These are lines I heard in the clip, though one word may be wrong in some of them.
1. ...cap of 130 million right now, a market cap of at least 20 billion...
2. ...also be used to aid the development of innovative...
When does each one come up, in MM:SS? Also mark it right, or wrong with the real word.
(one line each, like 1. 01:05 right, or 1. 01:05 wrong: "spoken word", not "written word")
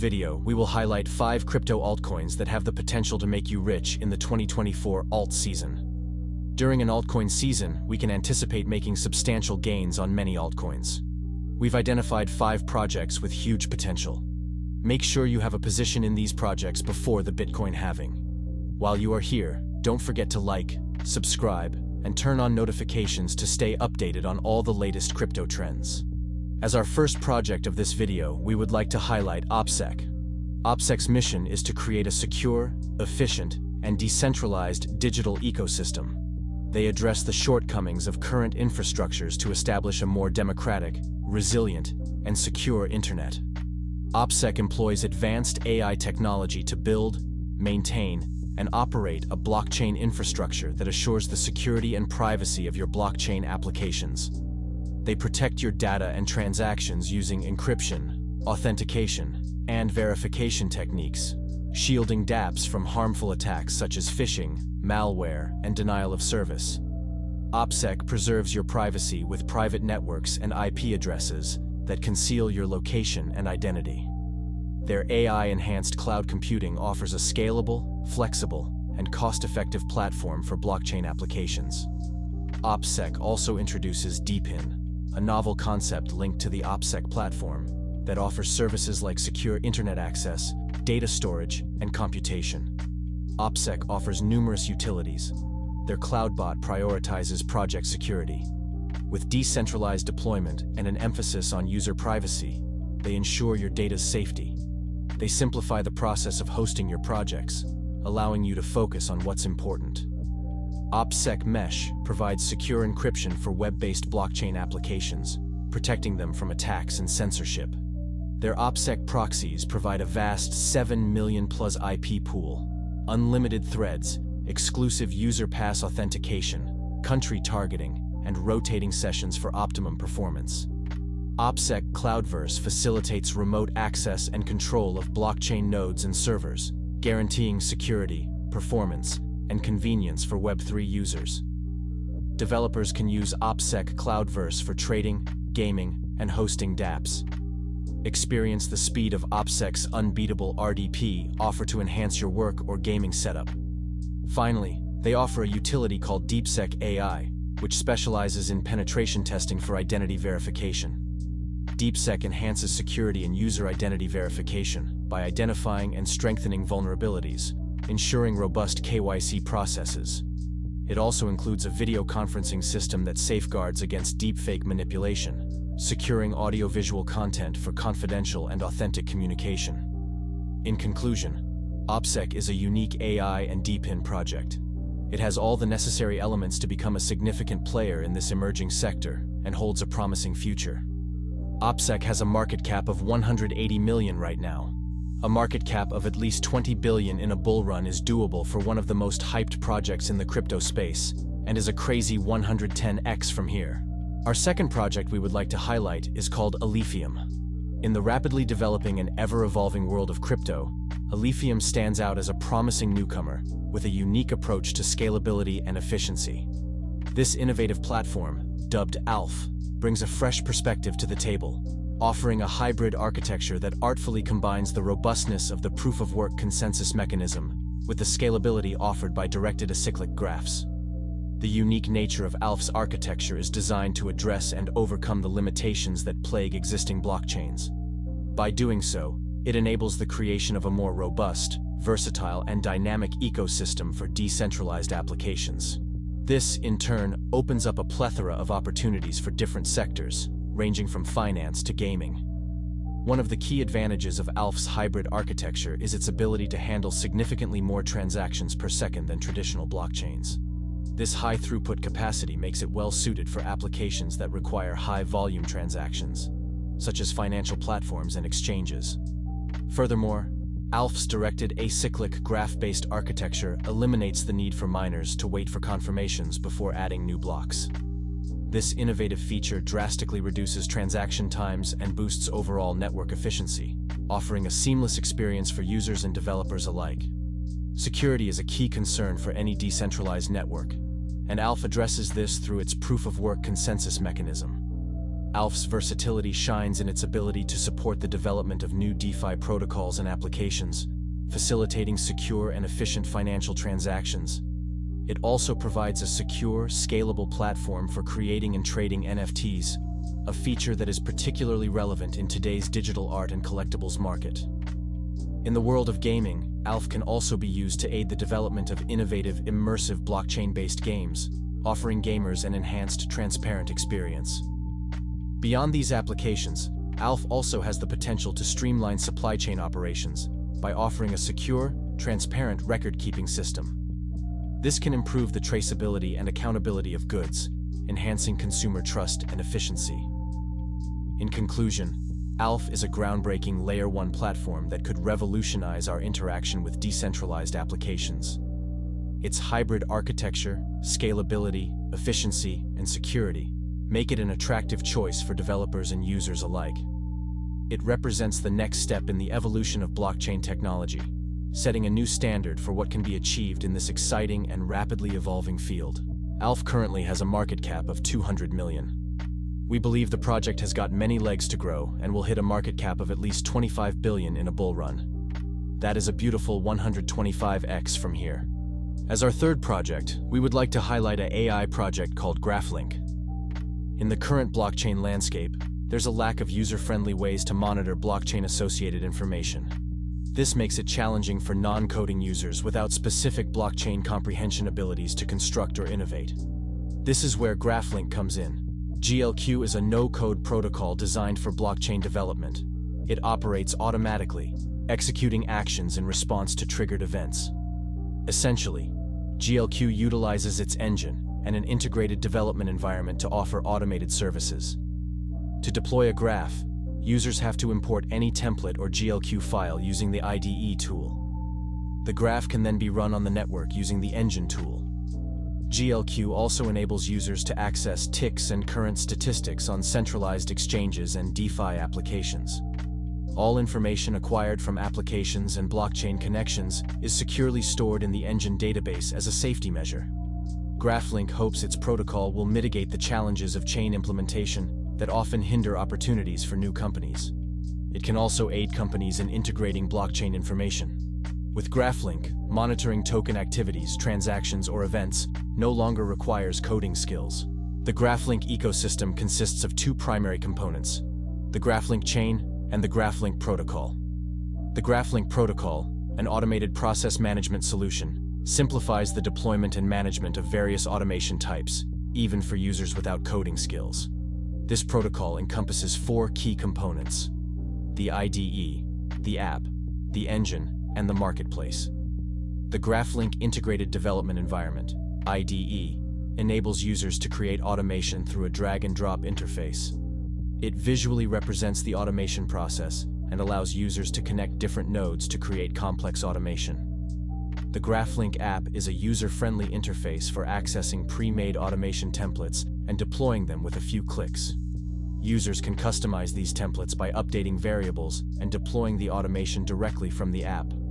1. 03:12 wrong: "180", not "130"
2. 05:17 right.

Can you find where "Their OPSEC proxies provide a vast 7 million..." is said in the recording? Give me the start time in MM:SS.
01:58.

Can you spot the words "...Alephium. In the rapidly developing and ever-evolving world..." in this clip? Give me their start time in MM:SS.
03:26.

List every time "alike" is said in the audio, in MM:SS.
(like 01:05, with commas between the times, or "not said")
04:46, 05:56.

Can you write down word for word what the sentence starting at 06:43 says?
It operates automatically, executing actions in response to triggered events.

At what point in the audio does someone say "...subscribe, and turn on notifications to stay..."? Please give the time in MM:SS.
00:21.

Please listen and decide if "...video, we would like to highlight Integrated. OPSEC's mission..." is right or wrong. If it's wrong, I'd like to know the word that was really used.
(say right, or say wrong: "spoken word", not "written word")
wrong: "OPSEC", not "Integrated".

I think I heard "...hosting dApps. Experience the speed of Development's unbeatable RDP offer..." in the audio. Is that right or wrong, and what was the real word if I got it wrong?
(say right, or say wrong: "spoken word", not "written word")
wrong: "OPSEC", not "Development".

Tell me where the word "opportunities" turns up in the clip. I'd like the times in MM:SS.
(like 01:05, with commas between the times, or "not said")
04:08, 07:25.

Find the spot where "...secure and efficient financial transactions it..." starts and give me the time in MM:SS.
05:01.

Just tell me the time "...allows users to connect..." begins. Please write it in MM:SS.
08:13.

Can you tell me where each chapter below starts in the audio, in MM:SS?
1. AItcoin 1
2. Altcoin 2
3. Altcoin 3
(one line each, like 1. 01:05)
1. 00:26
2. 03:24
3. 06:19.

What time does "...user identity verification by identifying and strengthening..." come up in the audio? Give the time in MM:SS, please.
02:43.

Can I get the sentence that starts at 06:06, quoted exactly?
ALPH currently has a market cap of 200 million.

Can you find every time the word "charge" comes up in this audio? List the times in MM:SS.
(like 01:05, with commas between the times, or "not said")
not said.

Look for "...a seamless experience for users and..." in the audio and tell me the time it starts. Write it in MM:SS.
04:44.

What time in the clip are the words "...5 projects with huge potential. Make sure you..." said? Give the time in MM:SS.
00:12.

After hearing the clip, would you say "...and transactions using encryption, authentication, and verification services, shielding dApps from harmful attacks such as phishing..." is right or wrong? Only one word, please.
wrong.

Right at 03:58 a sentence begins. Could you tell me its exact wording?
By doing so, it enables the creation of a more robust, versatile, and dynamic ecosystem for decentralized applications.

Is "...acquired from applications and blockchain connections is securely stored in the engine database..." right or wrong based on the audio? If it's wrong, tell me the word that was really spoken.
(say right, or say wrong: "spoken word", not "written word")
right.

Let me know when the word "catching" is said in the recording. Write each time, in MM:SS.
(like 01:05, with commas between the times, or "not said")
not said.